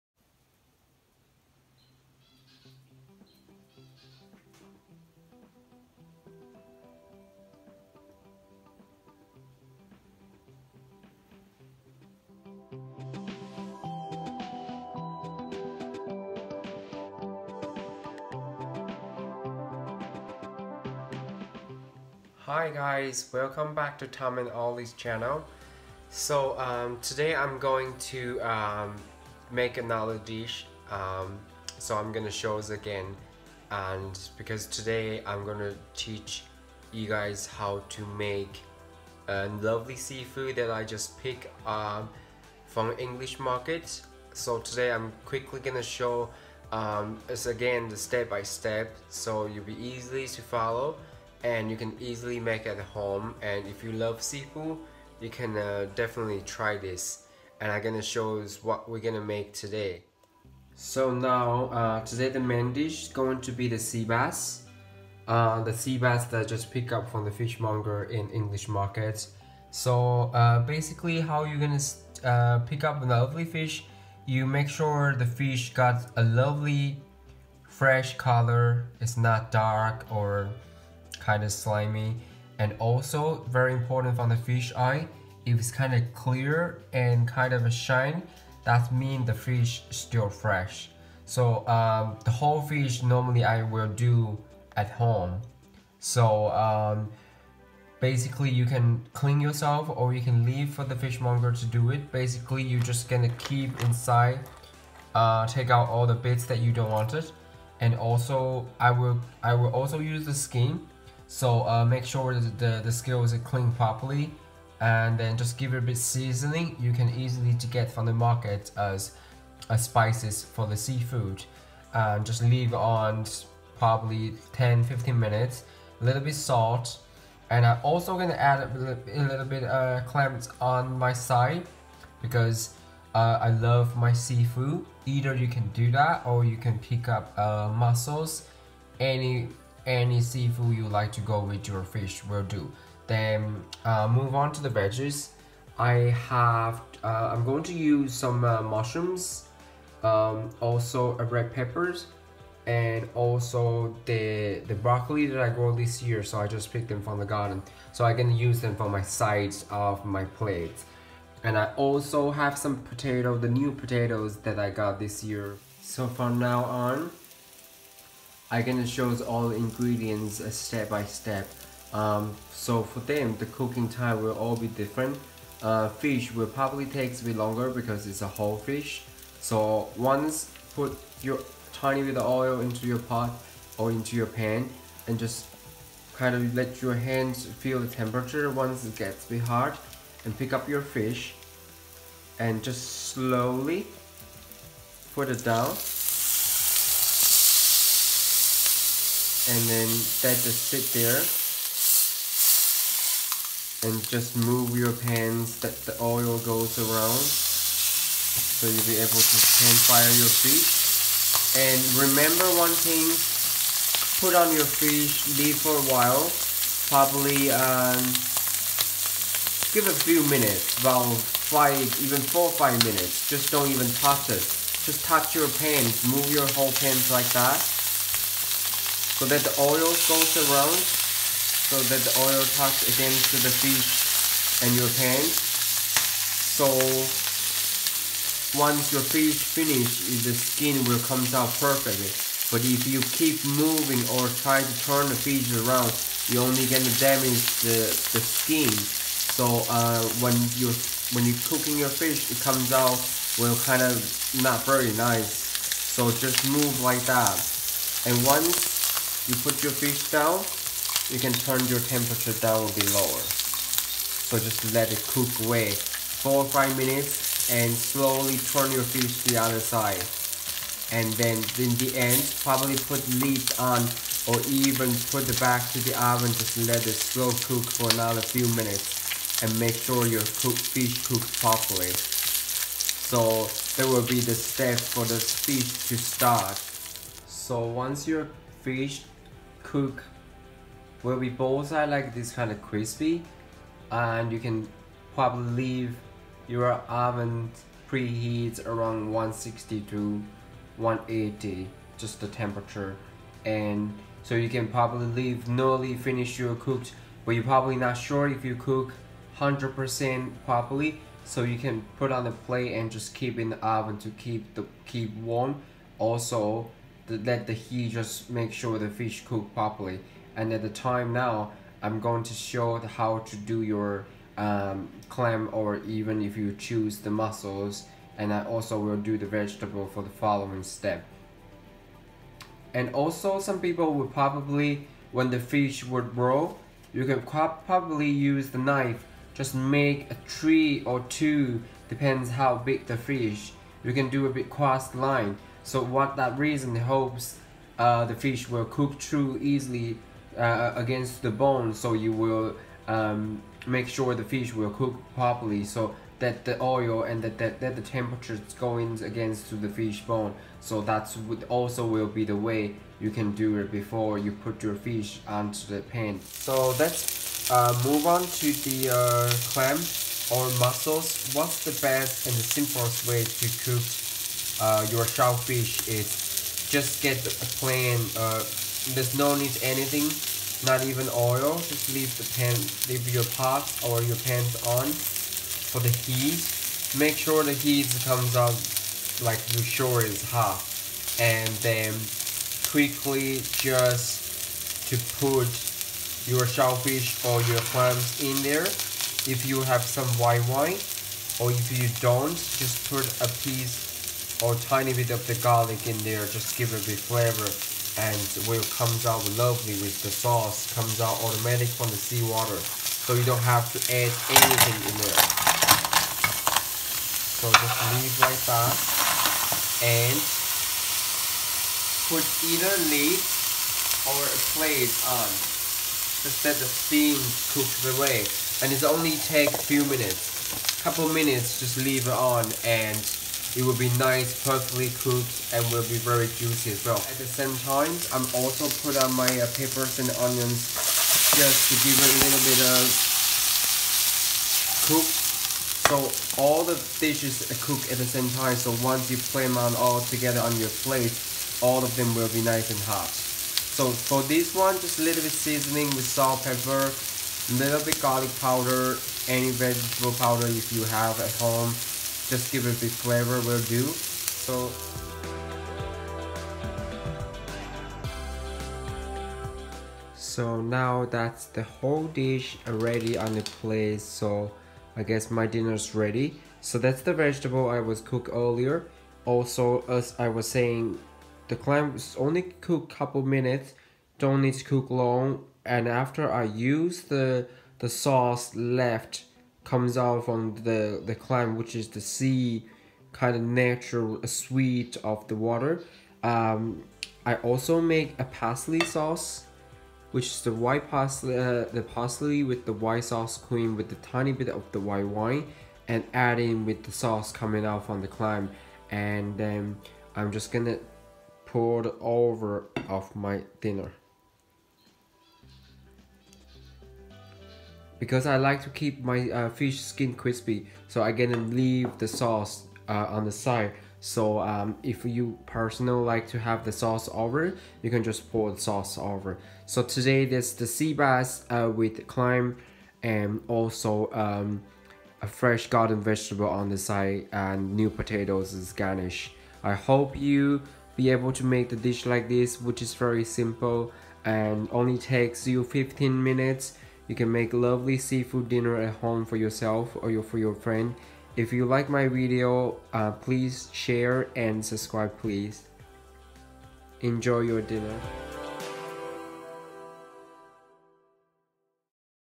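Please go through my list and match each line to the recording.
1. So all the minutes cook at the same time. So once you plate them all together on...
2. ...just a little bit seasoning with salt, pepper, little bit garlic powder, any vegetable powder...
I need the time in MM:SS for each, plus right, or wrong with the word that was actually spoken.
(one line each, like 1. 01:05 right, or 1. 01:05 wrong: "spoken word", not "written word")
1. 07:25 wrong: "dishes", not "minutes"
2. 07:34 right.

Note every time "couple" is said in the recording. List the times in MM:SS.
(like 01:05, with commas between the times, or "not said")
07:10, 08:02.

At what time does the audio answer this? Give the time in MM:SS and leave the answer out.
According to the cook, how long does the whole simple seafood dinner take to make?
09:05.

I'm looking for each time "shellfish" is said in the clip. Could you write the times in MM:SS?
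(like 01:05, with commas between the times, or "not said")
06:15, 06:36.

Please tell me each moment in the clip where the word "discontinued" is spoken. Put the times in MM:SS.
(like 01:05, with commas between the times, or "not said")
not said.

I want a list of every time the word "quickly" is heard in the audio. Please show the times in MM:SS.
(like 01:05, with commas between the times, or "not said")
00:45, 06:32.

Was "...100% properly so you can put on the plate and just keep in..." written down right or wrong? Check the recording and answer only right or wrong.
right.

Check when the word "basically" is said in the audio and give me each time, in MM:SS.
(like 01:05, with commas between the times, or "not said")
01:10, 01:37, 01:42.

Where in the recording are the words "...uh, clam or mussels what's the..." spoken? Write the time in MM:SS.
06:08.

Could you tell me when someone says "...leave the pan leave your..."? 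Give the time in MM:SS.
06:21.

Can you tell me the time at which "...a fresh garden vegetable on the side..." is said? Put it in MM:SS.
08:55.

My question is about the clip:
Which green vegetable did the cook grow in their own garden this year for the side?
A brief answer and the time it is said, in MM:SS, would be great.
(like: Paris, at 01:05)
Broccoli, at 02:34.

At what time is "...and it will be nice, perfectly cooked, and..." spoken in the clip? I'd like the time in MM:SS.
07:12.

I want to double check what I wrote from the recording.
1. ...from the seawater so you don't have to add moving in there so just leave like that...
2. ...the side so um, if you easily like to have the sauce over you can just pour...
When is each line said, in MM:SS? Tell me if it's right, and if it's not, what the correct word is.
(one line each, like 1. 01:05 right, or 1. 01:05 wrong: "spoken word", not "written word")
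1. 06:51 wrong: "anything", not "moving"
2. 08:43 wrong: "personally", not "easily".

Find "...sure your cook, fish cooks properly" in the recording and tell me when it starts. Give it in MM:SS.
04:39.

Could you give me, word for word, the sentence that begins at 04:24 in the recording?
So just let it cook away 4 or 5 minutes and slowly turn your fish to the other side.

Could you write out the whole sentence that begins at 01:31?
So um, the whole fish normally I will do at home.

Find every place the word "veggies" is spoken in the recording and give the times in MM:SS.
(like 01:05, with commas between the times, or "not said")
02:24.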